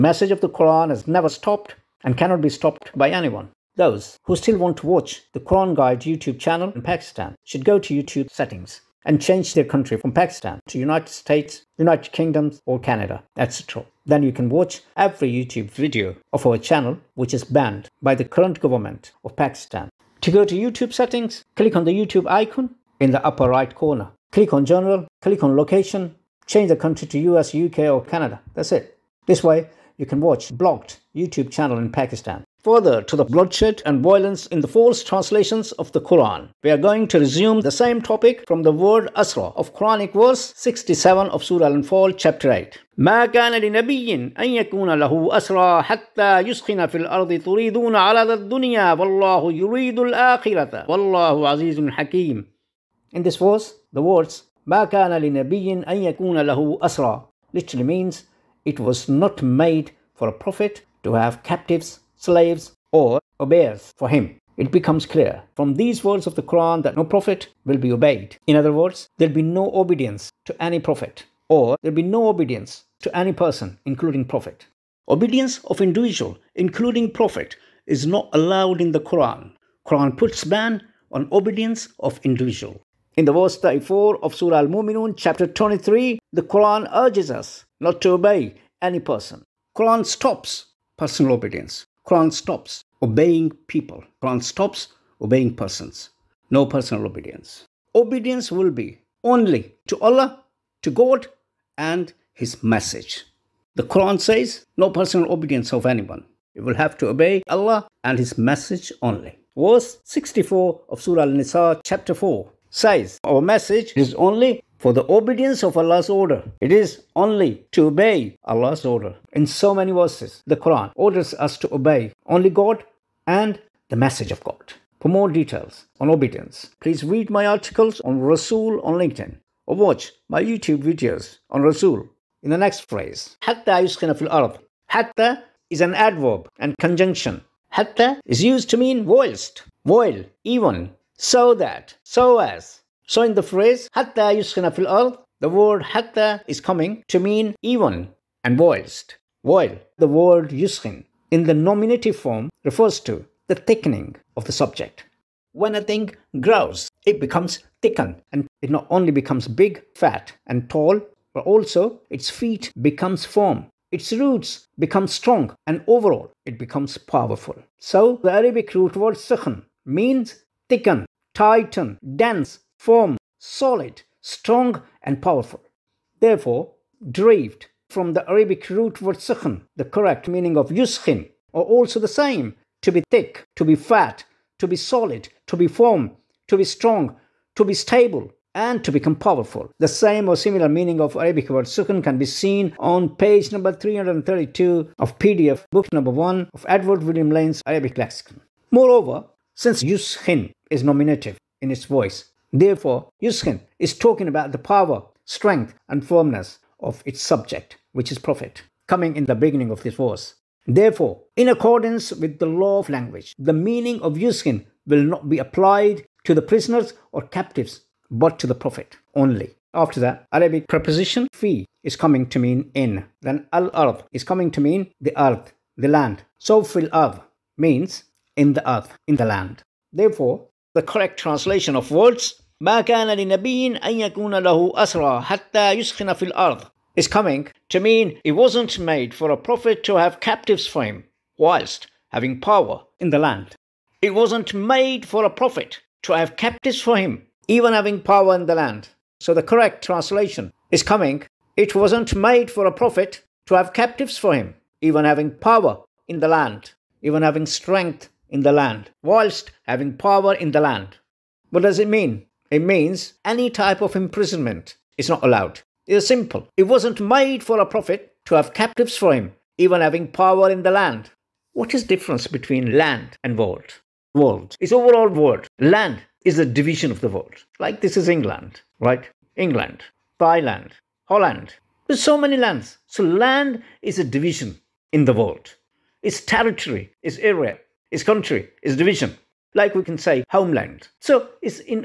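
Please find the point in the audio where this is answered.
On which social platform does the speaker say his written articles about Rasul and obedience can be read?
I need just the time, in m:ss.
2:08.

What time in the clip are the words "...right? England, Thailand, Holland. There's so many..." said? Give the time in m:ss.
4:38.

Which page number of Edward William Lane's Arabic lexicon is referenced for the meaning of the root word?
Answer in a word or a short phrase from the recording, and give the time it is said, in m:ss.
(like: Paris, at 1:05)
332, at 3:13.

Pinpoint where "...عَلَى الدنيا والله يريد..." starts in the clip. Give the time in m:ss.
0:47.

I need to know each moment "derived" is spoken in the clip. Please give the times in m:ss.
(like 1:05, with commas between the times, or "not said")
2:57.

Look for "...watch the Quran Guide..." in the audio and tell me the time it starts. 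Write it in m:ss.
0:04.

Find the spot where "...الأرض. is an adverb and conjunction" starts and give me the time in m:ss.
2:14.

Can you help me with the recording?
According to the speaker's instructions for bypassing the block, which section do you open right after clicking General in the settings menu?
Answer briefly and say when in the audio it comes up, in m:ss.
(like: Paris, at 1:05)
Location, at 0:25.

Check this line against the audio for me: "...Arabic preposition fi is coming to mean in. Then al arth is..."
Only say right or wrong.
right.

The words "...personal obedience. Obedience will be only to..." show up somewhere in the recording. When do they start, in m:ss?
1:36.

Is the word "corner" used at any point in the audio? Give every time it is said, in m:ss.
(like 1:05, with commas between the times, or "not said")
0:23.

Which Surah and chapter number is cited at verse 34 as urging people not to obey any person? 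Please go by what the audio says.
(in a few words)
Surah Al-Muminun, chapter 23.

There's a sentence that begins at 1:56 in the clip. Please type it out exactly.
It is only to obey Allah's order.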